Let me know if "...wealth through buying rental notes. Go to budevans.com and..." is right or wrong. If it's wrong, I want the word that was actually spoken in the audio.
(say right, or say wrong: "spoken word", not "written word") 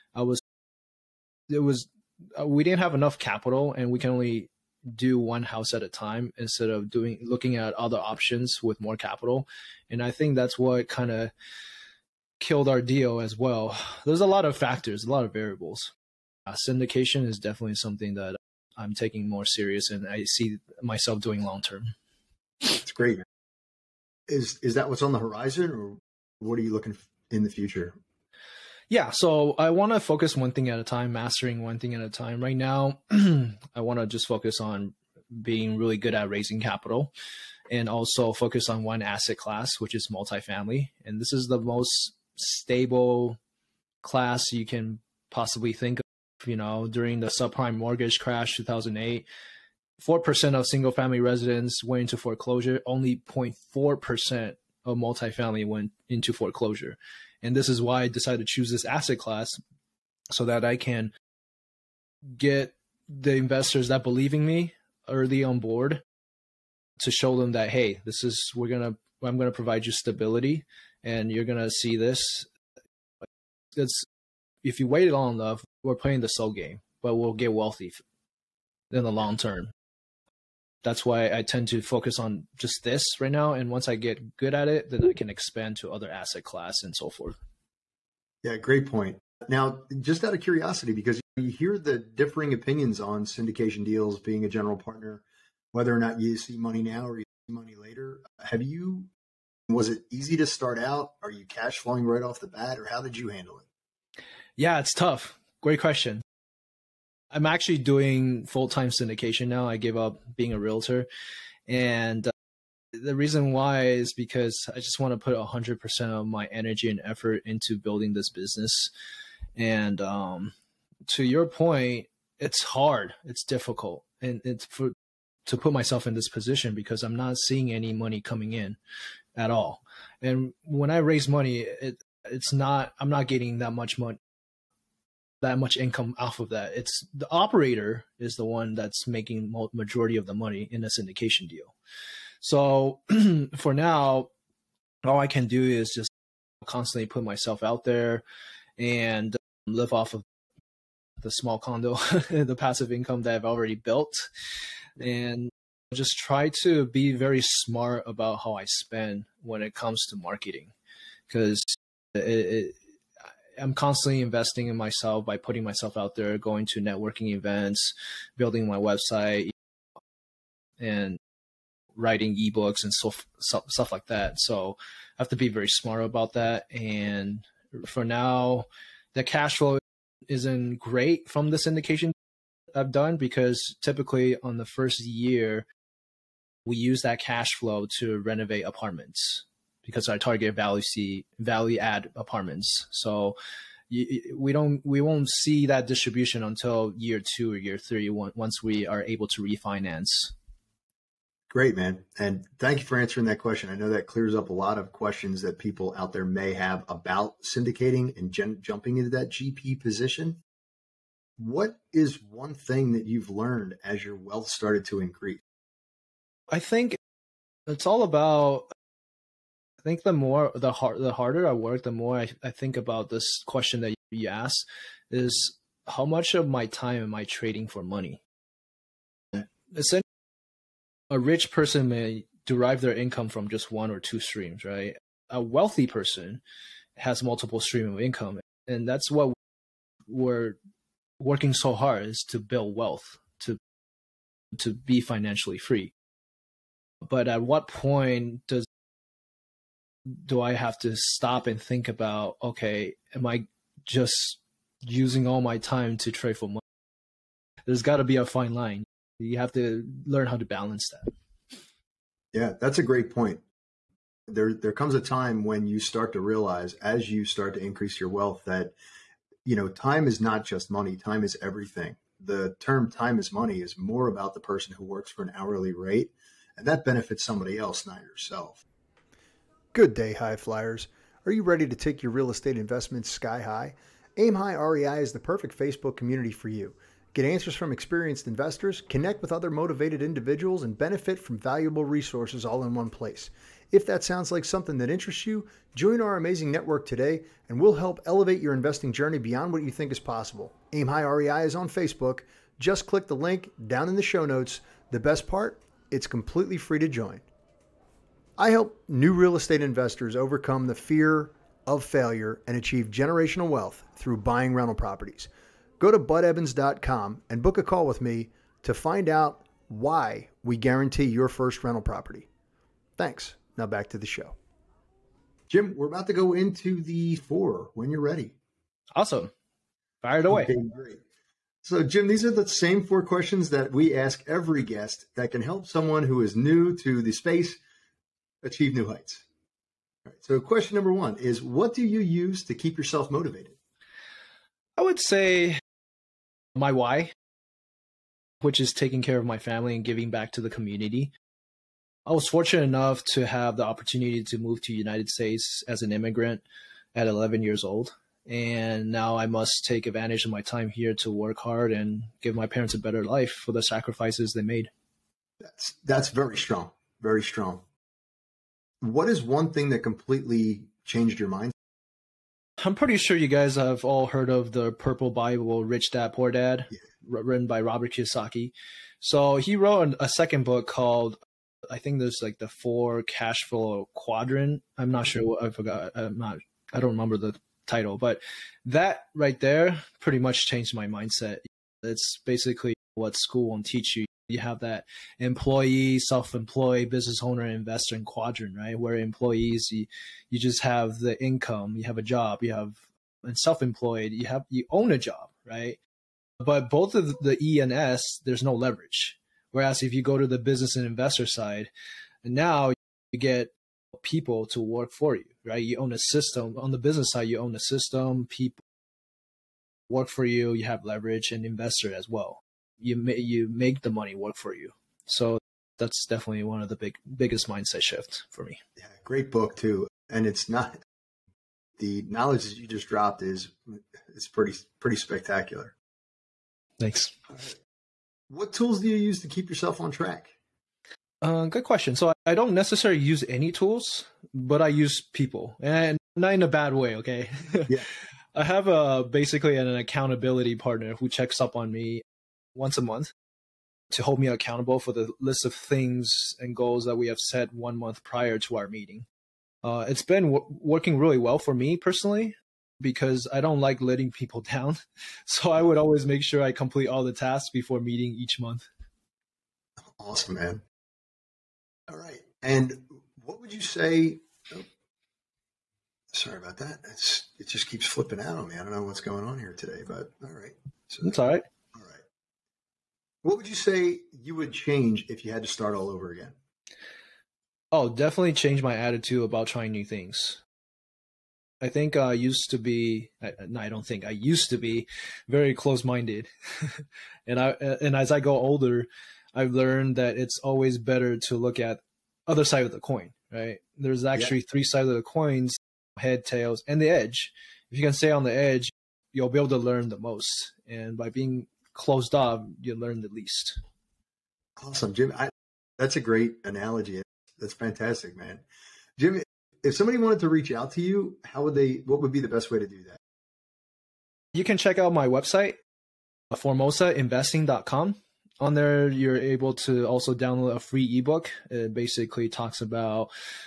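wrong: "properties", not "notes".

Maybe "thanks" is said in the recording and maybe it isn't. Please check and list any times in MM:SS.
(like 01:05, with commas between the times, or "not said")
03:22, 05:22, 07:16.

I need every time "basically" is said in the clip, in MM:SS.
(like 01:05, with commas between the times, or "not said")
06:32, 07:29, 08:51.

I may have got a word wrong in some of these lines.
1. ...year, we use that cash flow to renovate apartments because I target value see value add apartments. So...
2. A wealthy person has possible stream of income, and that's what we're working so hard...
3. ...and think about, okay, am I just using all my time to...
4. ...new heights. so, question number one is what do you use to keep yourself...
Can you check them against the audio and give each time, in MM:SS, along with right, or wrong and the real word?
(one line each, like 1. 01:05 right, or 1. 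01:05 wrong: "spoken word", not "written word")
1. 03:05 right
2. 03:55 wrong: "multiple", not "possible"
3. 04:11 right
4. 05:38 right.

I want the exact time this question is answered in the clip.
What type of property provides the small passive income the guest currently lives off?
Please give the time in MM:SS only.
02:31.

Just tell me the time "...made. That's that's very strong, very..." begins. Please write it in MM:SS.
06:04.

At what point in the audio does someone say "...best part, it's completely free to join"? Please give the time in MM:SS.
05:04.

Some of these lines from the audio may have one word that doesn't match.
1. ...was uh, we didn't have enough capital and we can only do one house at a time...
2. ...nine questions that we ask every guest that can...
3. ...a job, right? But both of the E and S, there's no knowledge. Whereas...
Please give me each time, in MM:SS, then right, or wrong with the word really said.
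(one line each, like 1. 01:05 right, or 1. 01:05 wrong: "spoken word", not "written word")
1. 00:01 right
2. 05:32 wrong: "four", not "nine"
3. 06:44 wrong: "leverage", not "knowledge".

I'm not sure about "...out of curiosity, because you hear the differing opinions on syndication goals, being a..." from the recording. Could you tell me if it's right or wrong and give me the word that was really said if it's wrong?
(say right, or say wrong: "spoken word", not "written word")
wrong: "deals", not "goals".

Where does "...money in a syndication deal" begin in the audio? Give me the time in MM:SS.
02:20.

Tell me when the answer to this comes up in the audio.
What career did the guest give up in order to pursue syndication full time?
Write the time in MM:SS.
01:50.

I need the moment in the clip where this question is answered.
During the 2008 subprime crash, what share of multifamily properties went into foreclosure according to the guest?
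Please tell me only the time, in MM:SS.
00:53.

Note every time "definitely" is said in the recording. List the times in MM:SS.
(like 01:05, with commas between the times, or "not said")
00:17, 07:06, 08:07.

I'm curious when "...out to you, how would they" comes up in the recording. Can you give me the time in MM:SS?
08:40.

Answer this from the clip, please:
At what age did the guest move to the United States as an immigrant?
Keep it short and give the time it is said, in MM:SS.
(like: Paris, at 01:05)
11, at 05:57.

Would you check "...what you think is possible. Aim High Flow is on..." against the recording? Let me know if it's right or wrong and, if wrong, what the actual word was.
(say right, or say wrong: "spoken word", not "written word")
wrong: "REI", not "Flow".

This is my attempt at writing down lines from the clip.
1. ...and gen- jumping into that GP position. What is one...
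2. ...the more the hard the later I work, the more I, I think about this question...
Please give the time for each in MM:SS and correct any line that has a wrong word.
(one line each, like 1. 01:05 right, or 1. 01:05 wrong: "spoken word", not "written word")
1. 03:28 right
2. 03:40 wrong: "harder", not "later".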